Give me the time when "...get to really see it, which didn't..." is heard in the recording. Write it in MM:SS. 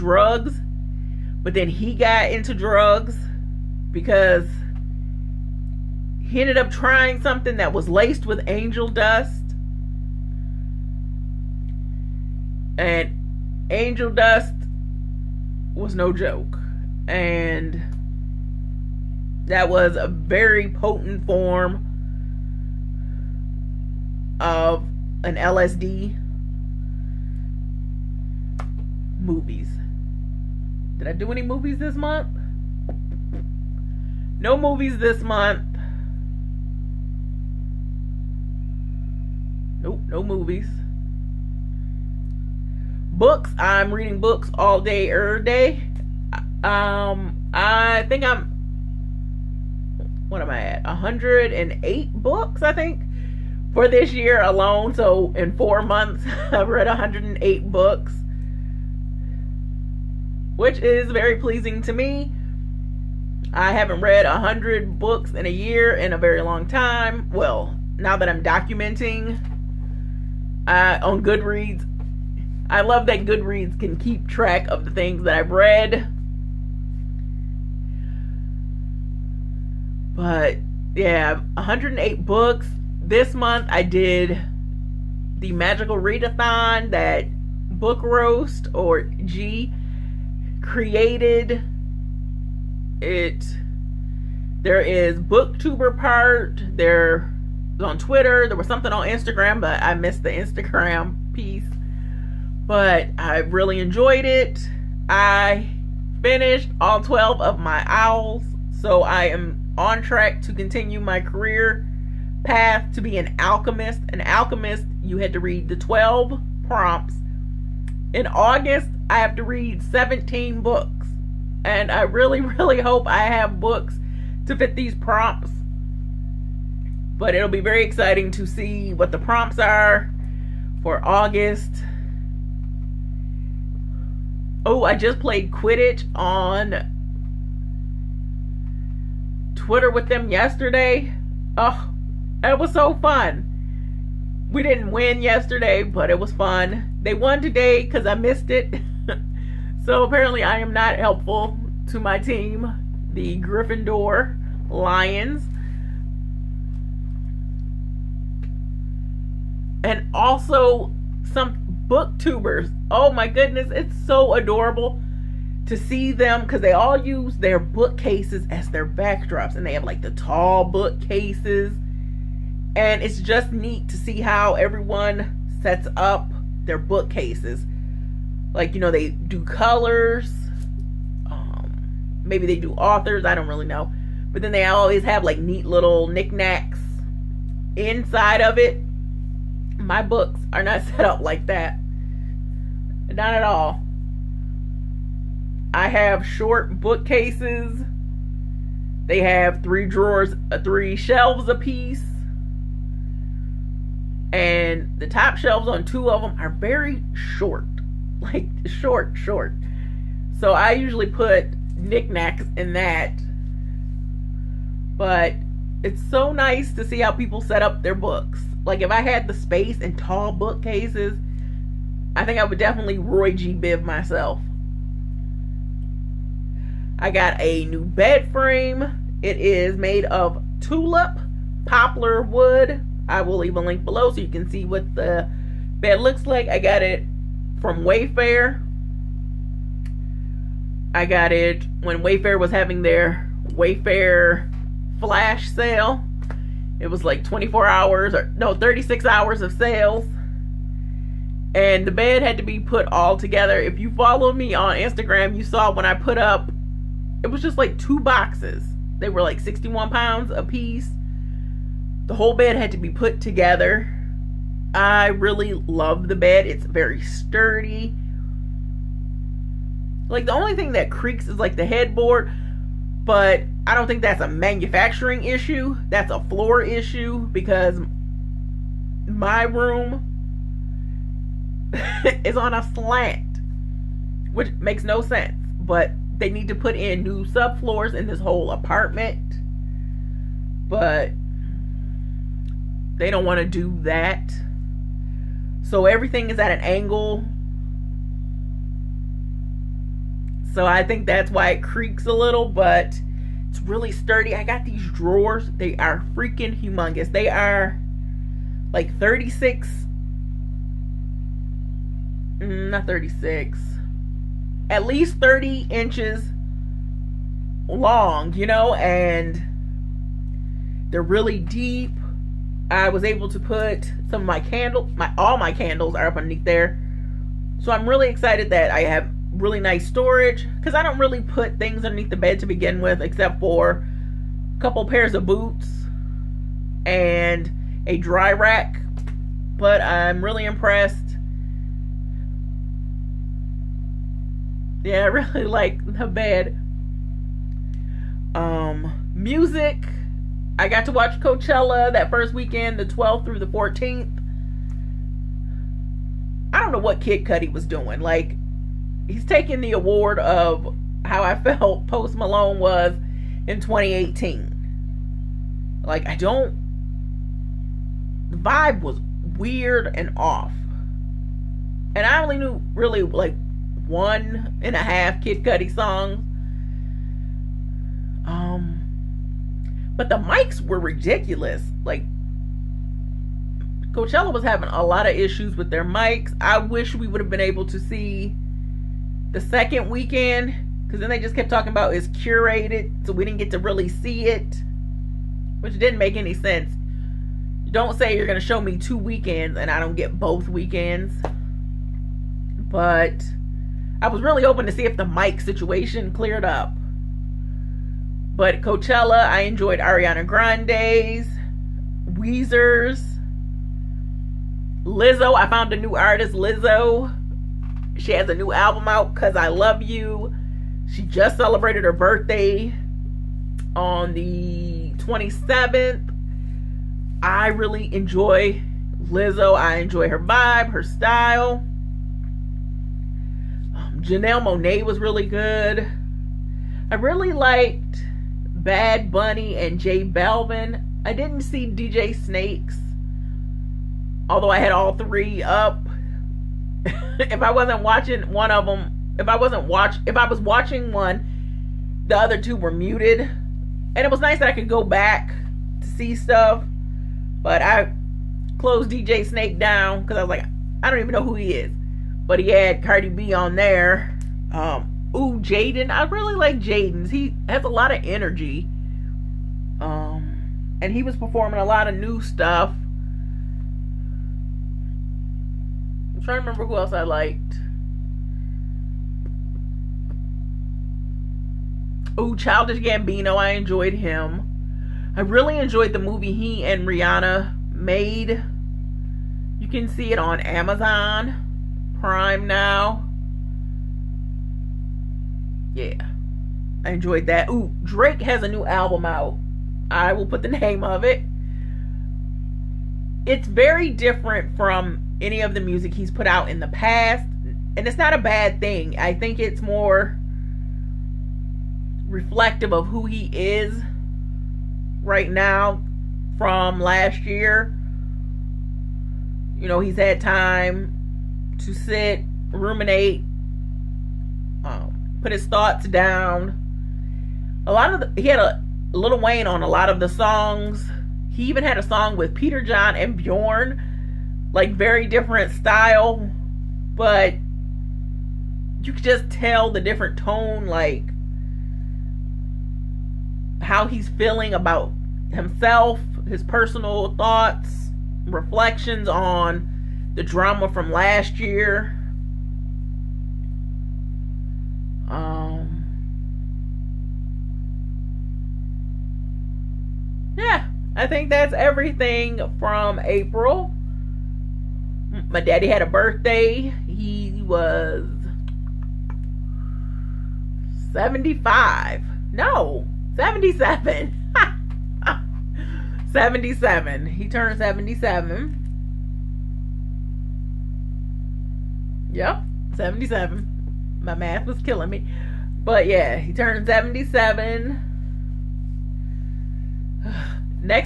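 06:33.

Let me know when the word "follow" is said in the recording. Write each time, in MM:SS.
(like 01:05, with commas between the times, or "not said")
04:13.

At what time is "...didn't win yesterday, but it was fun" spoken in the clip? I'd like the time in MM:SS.
02:24.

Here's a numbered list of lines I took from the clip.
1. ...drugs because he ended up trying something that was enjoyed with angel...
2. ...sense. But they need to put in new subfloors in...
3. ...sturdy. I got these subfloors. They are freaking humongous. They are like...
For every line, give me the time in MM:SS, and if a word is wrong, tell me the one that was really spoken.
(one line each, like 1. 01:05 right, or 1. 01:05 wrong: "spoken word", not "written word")
1. 00:02 wrong: "laced", not "enjoyed"
2. 04:45 right
3. 05:03 wrong: "drawers", not "subfloors".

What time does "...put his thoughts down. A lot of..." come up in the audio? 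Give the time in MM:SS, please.
08:45.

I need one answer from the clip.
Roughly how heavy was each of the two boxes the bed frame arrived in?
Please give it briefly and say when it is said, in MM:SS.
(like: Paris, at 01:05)
61 pounds, at 04:19.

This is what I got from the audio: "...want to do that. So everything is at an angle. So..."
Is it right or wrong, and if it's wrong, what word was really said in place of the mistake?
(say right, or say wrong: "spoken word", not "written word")
right.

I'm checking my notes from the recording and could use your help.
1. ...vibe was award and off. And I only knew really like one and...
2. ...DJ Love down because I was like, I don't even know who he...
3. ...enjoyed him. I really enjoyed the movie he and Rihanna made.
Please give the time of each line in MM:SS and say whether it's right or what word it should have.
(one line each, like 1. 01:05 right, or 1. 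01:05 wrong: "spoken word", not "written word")
1. 06:08 wrong: "weird", not "award"
2. 07:38 wrong: "Snake", not "Love"
3. 08:03 right.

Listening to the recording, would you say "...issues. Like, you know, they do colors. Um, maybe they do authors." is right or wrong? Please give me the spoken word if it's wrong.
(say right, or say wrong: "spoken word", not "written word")
wrong: "bookcases", not "issues".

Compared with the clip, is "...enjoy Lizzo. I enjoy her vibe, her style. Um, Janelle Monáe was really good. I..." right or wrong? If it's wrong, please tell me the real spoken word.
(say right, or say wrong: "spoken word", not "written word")
right.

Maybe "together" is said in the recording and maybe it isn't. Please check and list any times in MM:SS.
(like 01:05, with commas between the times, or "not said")
04:13, 04:23.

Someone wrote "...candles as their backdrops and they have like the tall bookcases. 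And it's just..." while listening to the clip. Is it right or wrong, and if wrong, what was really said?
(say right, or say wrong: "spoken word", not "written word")
wrong: "bookcases", not "candles".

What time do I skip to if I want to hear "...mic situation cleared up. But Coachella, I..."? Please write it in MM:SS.
06:45.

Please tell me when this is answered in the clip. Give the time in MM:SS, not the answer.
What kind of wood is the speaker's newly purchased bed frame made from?
03:50.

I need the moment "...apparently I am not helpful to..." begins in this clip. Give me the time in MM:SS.
02:30.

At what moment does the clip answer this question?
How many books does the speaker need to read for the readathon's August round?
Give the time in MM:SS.
01:59.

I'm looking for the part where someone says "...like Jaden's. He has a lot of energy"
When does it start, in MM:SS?
07:46.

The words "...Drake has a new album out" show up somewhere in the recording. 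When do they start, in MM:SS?
08:17.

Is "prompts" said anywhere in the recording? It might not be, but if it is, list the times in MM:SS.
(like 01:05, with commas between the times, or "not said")
01:56, 02:04, 02:09.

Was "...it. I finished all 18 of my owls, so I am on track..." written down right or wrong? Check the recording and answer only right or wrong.
wrong.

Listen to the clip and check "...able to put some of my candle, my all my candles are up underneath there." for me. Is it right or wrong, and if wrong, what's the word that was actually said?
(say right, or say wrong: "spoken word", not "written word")
right.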